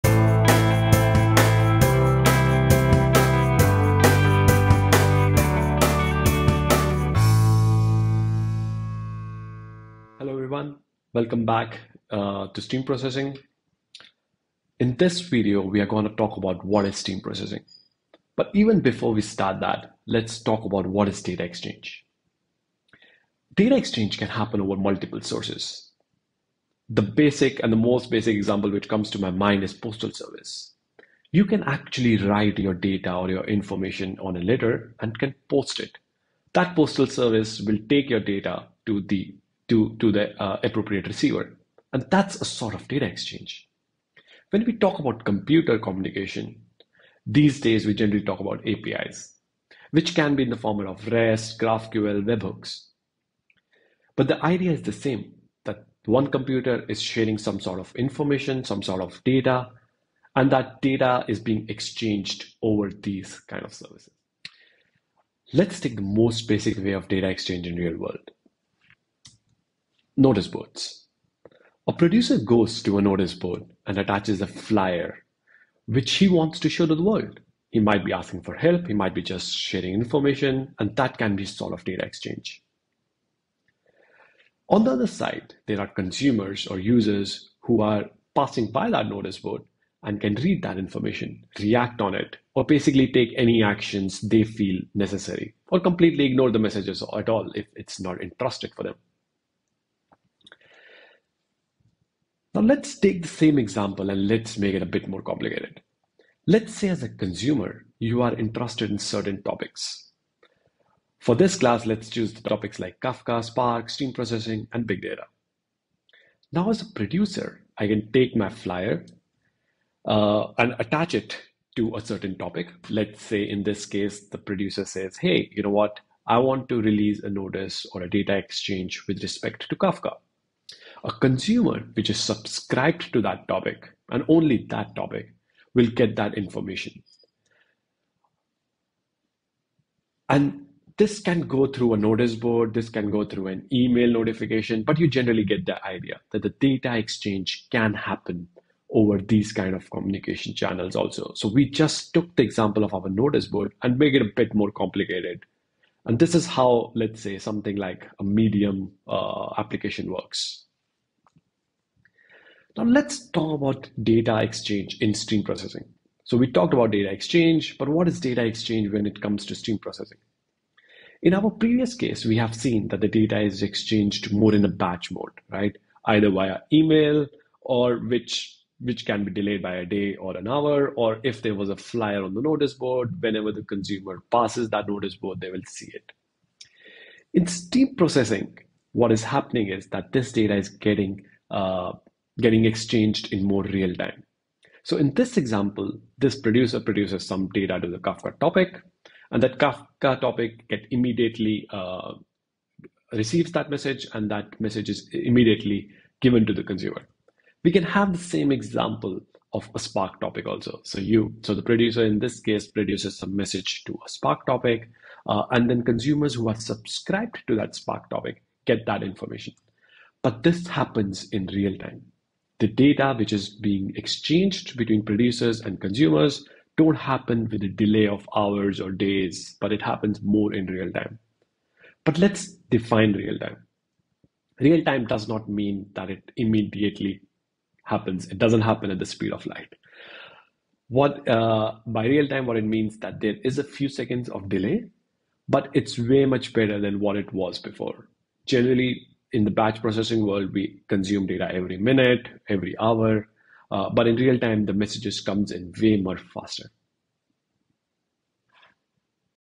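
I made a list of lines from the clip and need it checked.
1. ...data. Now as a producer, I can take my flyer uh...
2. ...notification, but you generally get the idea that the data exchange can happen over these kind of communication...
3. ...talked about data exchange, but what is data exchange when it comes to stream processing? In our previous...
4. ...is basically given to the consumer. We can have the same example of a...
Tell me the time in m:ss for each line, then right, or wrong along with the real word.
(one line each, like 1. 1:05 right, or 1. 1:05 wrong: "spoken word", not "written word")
1. 1:55 right
2. 2:24 right
3. 2:46 right
4. 3:24 wrong: "immediately", not "basically".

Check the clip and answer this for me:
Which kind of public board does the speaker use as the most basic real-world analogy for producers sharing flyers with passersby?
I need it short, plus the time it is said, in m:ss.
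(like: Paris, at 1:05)
Notice boards, at 1:10.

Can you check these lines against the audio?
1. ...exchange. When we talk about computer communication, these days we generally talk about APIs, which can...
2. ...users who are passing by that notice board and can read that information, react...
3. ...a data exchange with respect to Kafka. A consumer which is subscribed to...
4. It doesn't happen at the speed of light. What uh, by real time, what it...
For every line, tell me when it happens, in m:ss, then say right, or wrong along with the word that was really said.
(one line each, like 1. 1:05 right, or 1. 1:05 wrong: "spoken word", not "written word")
1. 0:43 right
2. 1:26 right
3. 2:08 right
4. 3:58 right.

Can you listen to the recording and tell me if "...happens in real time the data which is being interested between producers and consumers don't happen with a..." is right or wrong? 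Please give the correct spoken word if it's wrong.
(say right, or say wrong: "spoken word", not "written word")
wrong: "exchanged", not "interested".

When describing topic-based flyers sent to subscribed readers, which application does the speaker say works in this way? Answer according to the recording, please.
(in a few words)
Medium.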